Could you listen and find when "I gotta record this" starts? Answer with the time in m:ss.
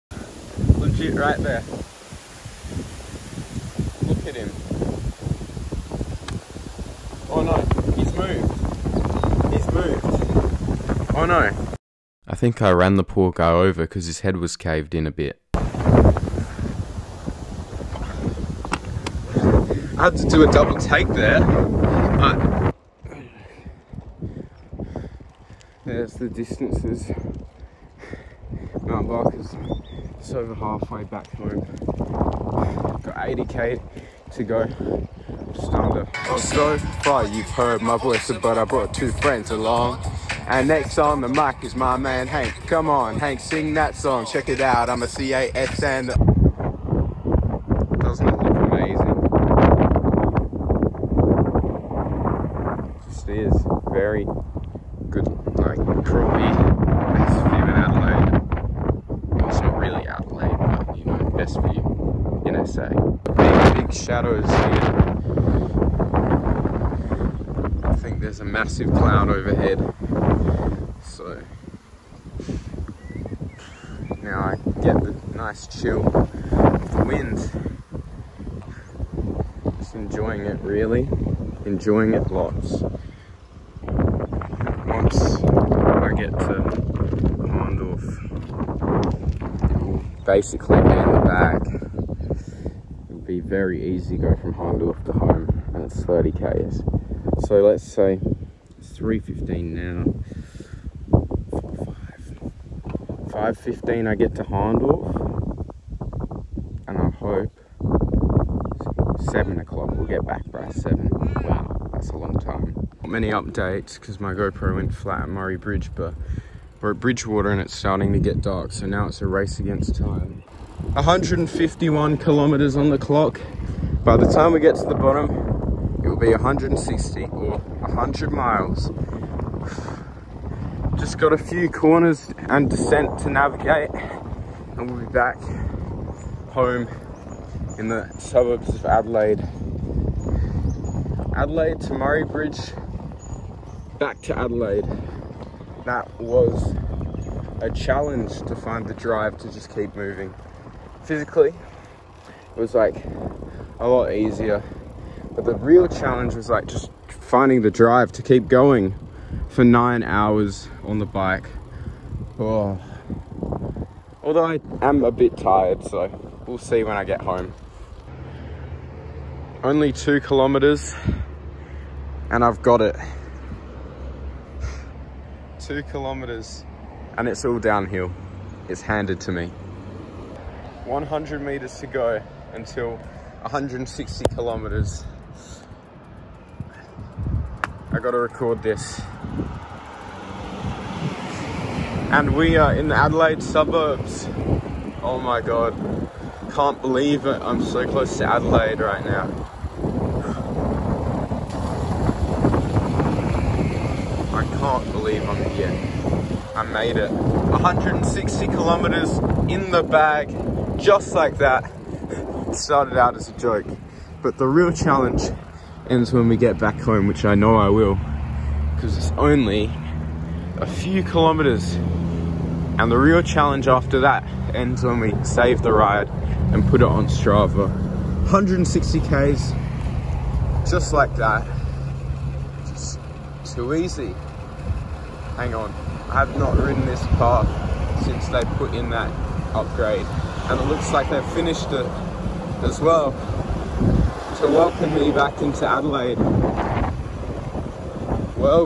3:07.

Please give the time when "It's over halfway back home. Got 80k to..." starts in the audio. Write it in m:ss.
0:30.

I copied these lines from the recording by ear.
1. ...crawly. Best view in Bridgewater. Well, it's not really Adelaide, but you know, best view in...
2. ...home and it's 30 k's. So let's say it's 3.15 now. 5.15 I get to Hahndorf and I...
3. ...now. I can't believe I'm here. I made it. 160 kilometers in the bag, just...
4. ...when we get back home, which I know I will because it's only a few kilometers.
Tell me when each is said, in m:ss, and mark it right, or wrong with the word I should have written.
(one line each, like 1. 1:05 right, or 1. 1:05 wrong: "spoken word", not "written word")
1. 0:56 wrong: "Adelaide", not "Bridgewater"
2. 1:35 right
3. 3:19 right
4. 3:36 right.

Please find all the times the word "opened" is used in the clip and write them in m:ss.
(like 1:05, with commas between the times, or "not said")
not said.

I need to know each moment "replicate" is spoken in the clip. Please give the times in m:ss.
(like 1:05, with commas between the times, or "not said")
not said.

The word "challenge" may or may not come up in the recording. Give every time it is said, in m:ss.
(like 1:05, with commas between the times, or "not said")
2:27, 2:35, 3:34, 3:43.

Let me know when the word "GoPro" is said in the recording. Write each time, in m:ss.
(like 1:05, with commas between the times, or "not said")
1:54.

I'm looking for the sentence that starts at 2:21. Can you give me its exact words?
Adelaide to Murray Bridge, back to Adelaide.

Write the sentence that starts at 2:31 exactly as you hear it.
Physically, it was like a lot easier.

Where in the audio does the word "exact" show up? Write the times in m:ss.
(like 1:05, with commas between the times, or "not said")
not said.